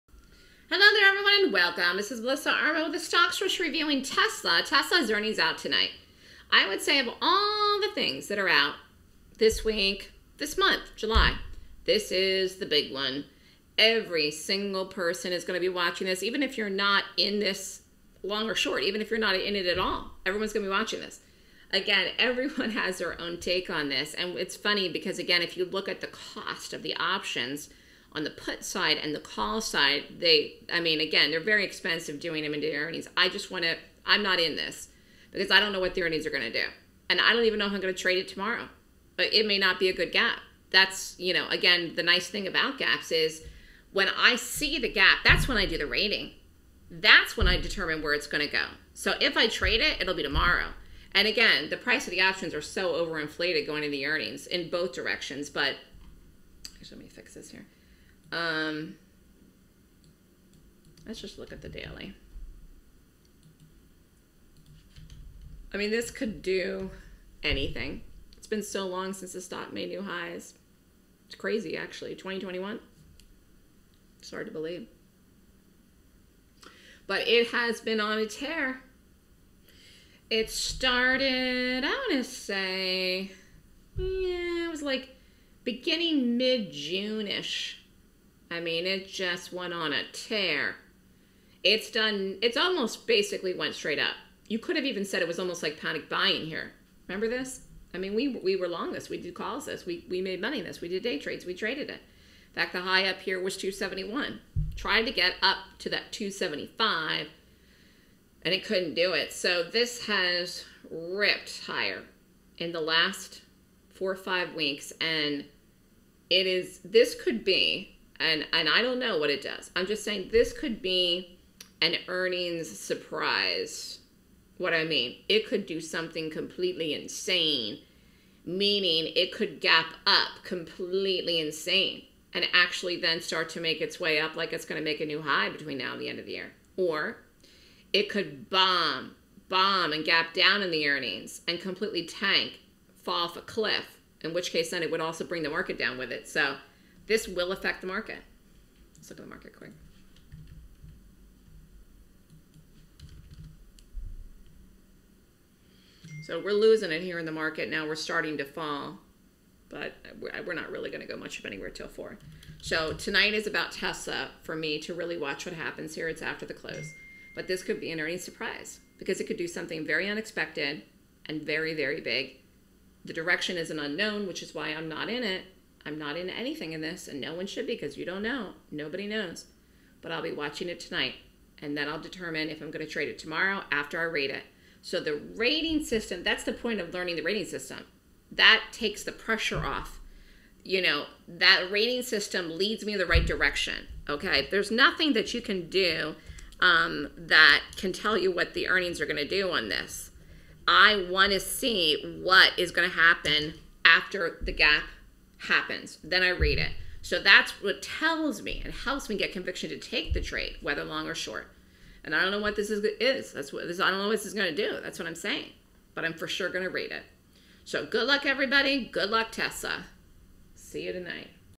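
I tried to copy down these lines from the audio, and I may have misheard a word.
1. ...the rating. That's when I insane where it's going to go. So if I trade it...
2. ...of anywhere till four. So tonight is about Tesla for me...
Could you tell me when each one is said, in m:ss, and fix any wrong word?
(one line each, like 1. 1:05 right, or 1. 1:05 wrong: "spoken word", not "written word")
1. 0:45 wrong: "determine", not "insane"
2. 2:41 right.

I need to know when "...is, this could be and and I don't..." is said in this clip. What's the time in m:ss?
1:56.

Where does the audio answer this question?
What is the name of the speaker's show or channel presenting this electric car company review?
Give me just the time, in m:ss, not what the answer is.
0:02.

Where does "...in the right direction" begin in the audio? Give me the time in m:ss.
3:12.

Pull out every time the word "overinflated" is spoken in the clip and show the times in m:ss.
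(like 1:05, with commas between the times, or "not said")
0:52.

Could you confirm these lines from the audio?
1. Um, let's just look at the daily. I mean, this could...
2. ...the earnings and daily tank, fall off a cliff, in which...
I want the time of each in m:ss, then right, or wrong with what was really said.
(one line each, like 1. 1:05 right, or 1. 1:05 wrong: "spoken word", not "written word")
1. 0:58 right
2. 2:20 wrong: "completely", not "daily".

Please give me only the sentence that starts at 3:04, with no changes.
So the rating system, that's the point of learning the rating system.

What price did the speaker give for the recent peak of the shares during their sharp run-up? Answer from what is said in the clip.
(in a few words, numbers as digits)
271.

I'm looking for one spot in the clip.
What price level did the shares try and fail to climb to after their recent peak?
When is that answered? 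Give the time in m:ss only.
1:46.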